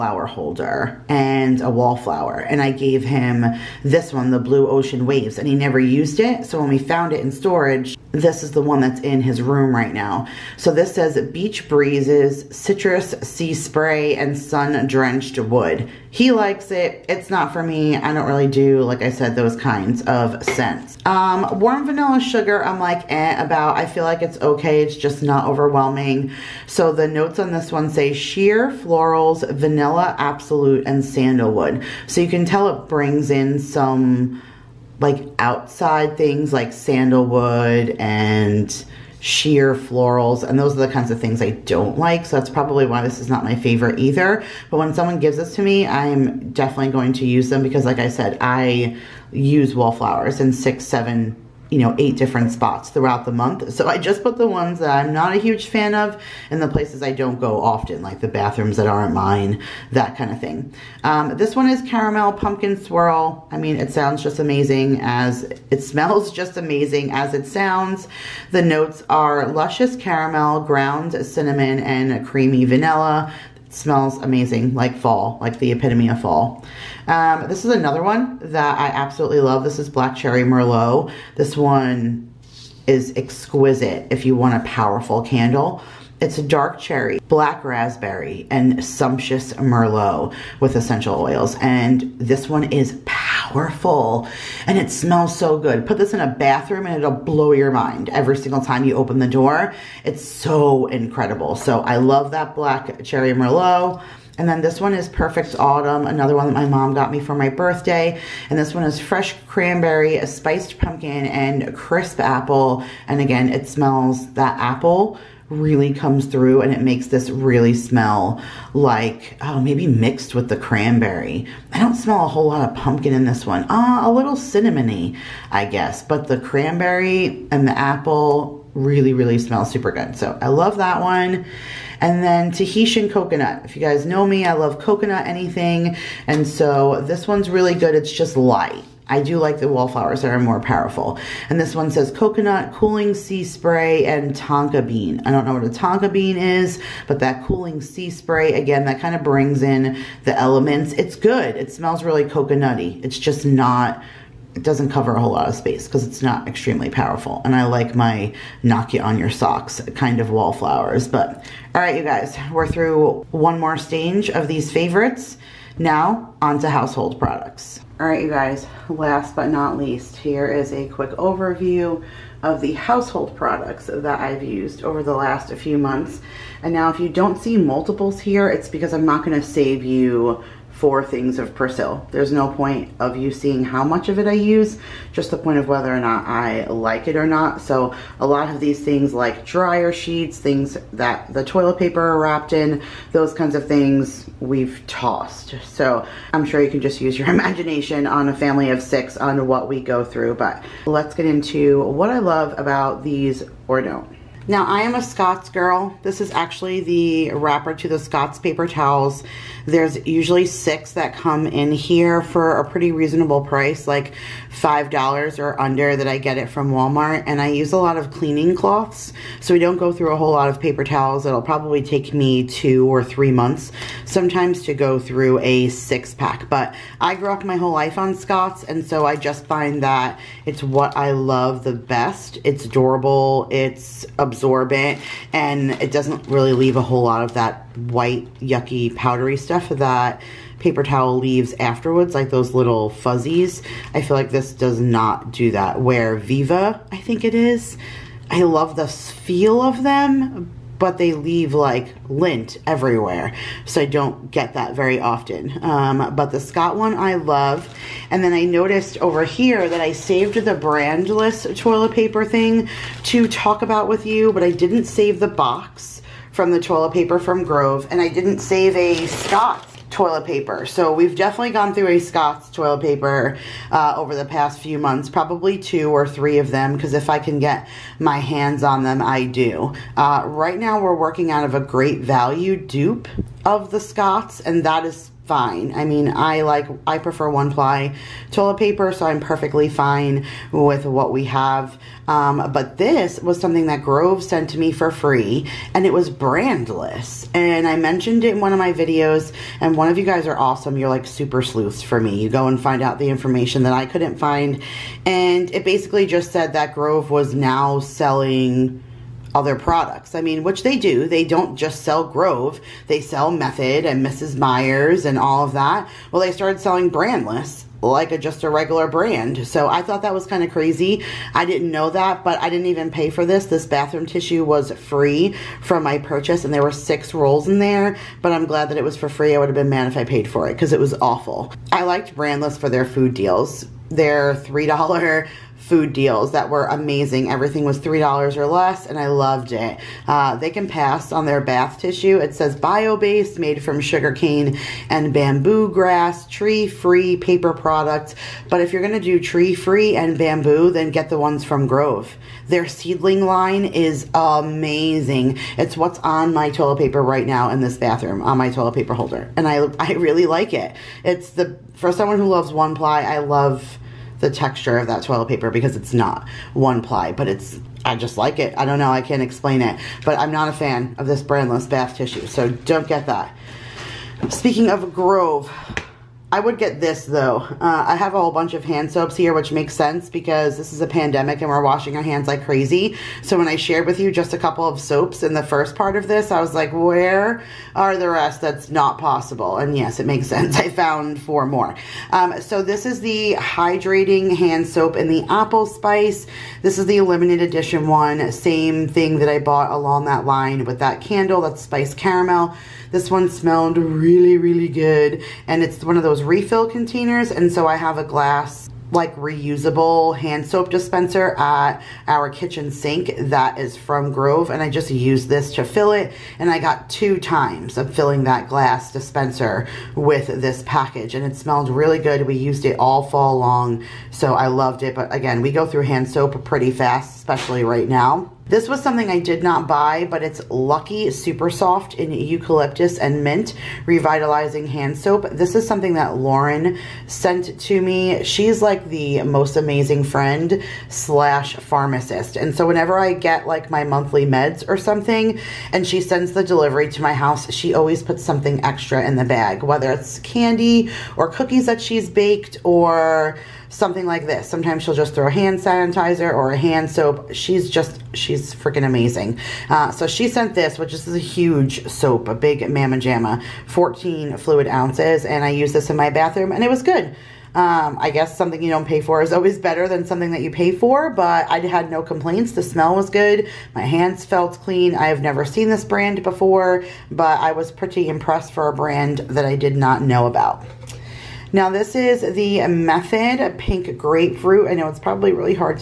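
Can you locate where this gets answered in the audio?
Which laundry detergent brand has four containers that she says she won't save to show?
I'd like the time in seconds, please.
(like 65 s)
181 s.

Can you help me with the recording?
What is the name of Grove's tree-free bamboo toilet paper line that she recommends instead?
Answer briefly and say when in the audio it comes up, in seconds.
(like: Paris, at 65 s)
Seedling, at 352 s.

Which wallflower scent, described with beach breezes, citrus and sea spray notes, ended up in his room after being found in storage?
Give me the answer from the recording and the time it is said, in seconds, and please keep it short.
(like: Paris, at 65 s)
Blue Ocean Waves, at 4 s.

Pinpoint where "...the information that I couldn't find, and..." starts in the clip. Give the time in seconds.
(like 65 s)
302 s.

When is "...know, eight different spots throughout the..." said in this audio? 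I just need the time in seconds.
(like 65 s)
51 s.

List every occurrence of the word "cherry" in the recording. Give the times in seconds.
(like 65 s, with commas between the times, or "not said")
80 s, 86 s, 103 s.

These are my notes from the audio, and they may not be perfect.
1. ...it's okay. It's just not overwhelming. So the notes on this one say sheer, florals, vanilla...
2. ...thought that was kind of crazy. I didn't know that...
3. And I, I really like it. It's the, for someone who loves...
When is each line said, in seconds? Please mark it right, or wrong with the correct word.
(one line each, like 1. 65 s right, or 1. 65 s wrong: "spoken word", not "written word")
1. 24 s right
2. 319 s right
3. 359 s right.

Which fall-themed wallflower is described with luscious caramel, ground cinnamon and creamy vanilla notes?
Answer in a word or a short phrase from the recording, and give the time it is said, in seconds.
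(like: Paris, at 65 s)
Caramel Pumpkin Swirl, at 61 s.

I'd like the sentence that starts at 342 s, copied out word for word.
It says bio-based, made from sugarcane and bamboo grass, tree-free paper products.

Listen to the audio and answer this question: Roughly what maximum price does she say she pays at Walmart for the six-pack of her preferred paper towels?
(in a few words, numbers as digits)
$5.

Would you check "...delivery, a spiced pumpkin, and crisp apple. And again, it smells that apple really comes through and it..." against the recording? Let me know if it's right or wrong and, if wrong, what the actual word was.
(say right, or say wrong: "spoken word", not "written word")
wrong: "cranberry", not "delivery".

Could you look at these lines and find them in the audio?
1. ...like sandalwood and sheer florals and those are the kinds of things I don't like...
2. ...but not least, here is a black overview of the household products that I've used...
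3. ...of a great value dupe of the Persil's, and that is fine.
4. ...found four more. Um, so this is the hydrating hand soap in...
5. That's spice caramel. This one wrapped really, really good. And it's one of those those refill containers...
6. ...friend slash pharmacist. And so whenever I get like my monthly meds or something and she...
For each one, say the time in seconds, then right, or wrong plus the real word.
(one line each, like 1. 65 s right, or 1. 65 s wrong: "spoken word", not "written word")
1. 36 s right
2. 169 s wrong: "quick", not "black"
3. 281 s wrong: "Scott", not "Persil"
4. 390 s right
5. 401 s wrong: "smelled", not "wrapped"
6. 440 s right.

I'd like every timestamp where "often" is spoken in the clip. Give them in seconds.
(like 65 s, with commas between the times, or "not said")
57 s, 254 s.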